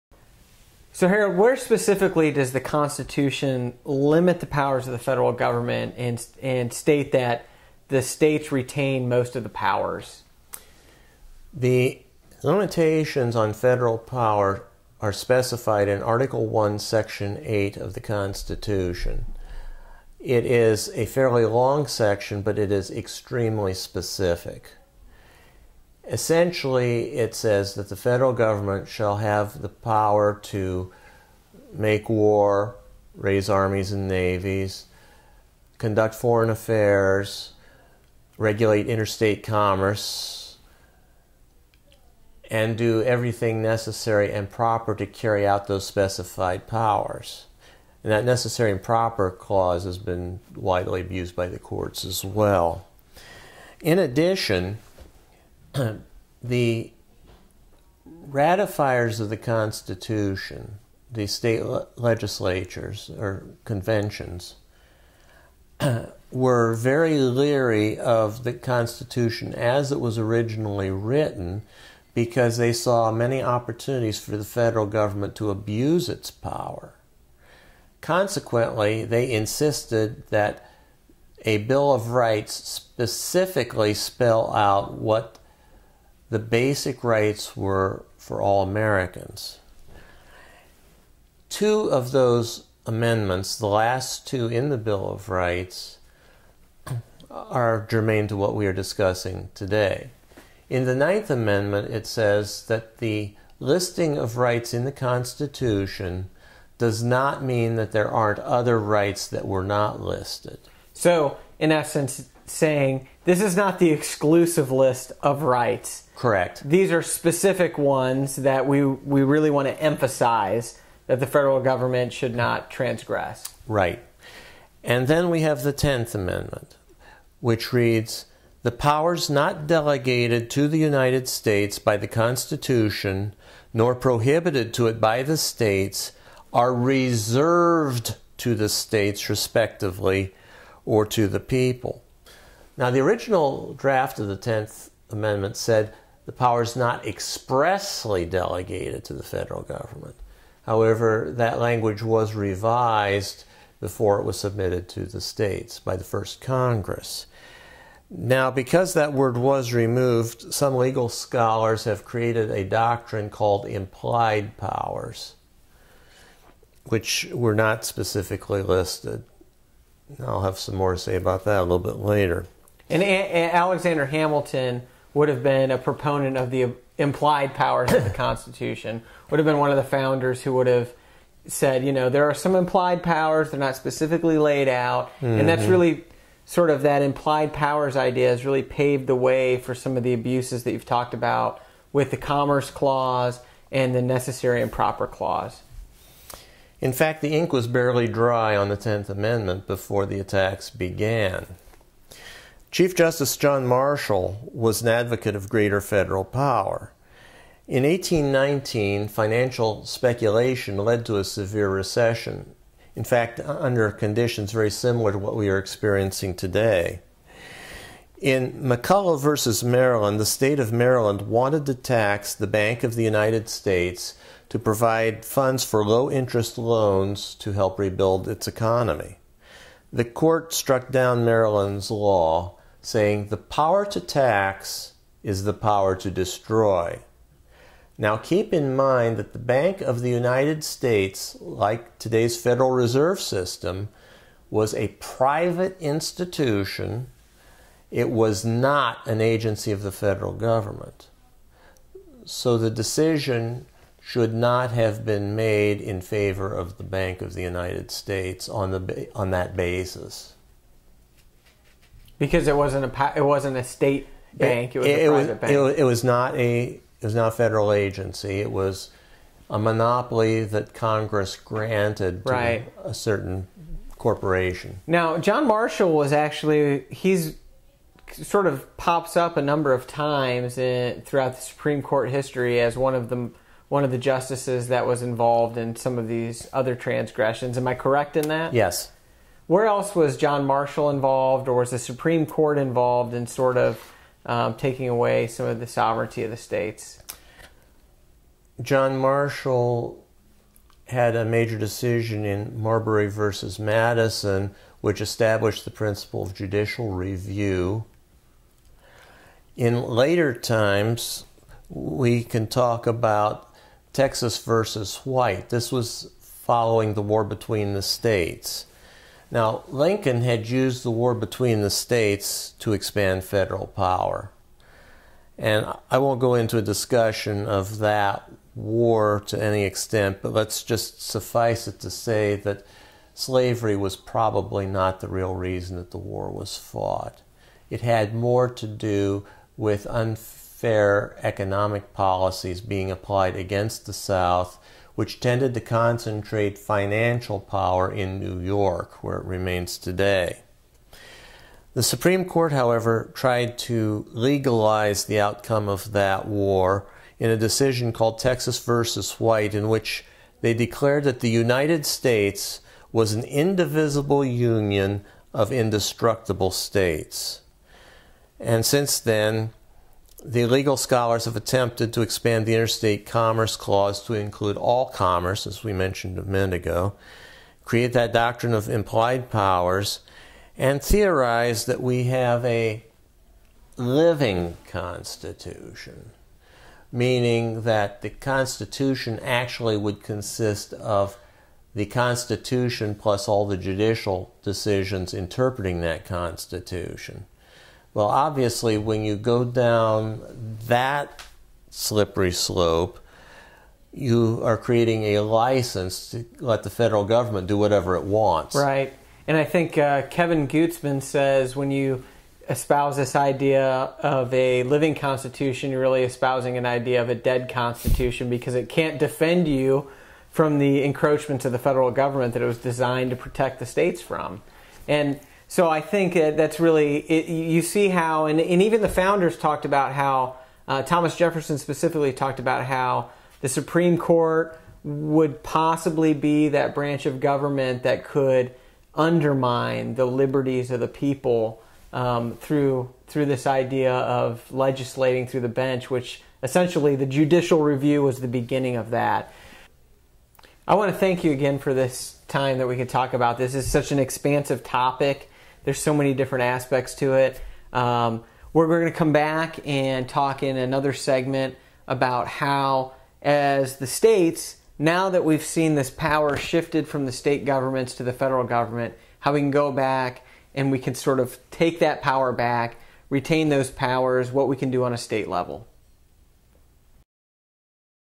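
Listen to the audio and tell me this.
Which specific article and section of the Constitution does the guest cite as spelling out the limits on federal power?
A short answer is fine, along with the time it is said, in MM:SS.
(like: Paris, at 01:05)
Article 1, Section 8, at 00:16.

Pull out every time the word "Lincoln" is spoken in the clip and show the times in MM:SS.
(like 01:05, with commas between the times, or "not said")
05:19.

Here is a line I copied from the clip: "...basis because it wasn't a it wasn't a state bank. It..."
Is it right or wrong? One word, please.
right.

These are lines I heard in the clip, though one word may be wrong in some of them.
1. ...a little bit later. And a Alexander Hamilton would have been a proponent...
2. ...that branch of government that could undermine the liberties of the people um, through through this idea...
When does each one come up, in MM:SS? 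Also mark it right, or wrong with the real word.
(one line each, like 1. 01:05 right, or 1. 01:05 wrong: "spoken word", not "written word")
1. 02:51 right
2. 07:16 right.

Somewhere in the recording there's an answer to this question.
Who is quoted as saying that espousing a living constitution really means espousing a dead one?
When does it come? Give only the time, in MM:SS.
06:50.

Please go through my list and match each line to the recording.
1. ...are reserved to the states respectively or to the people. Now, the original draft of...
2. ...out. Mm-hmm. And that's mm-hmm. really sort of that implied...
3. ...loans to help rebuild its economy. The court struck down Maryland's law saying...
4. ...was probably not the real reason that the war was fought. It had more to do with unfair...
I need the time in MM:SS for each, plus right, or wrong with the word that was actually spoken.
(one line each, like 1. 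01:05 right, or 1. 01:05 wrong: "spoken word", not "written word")
1. 02:16 right
2. 03:04 right
3. 03:46 right
4. 05:33 right.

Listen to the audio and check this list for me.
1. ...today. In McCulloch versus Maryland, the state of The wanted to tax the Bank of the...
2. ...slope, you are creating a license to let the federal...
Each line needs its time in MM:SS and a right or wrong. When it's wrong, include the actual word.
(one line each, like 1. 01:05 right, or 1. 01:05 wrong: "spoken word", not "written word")
1. 03:36 wrong: "Maryland", not "The"
2. 06:42 right.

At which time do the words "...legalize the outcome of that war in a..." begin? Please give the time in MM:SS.
05:54.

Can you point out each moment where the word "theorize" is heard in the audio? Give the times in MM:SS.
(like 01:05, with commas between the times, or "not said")
06:20.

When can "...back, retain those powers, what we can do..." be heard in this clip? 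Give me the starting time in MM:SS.
07:52.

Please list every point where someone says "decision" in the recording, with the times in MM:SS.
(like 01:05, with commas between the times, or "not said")
04:12, 05:01, 05:57, 06:34.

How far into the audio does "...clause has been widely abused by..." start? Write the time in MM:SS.
00:49.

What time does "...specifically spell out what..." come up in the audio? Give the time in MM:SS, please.
01:22.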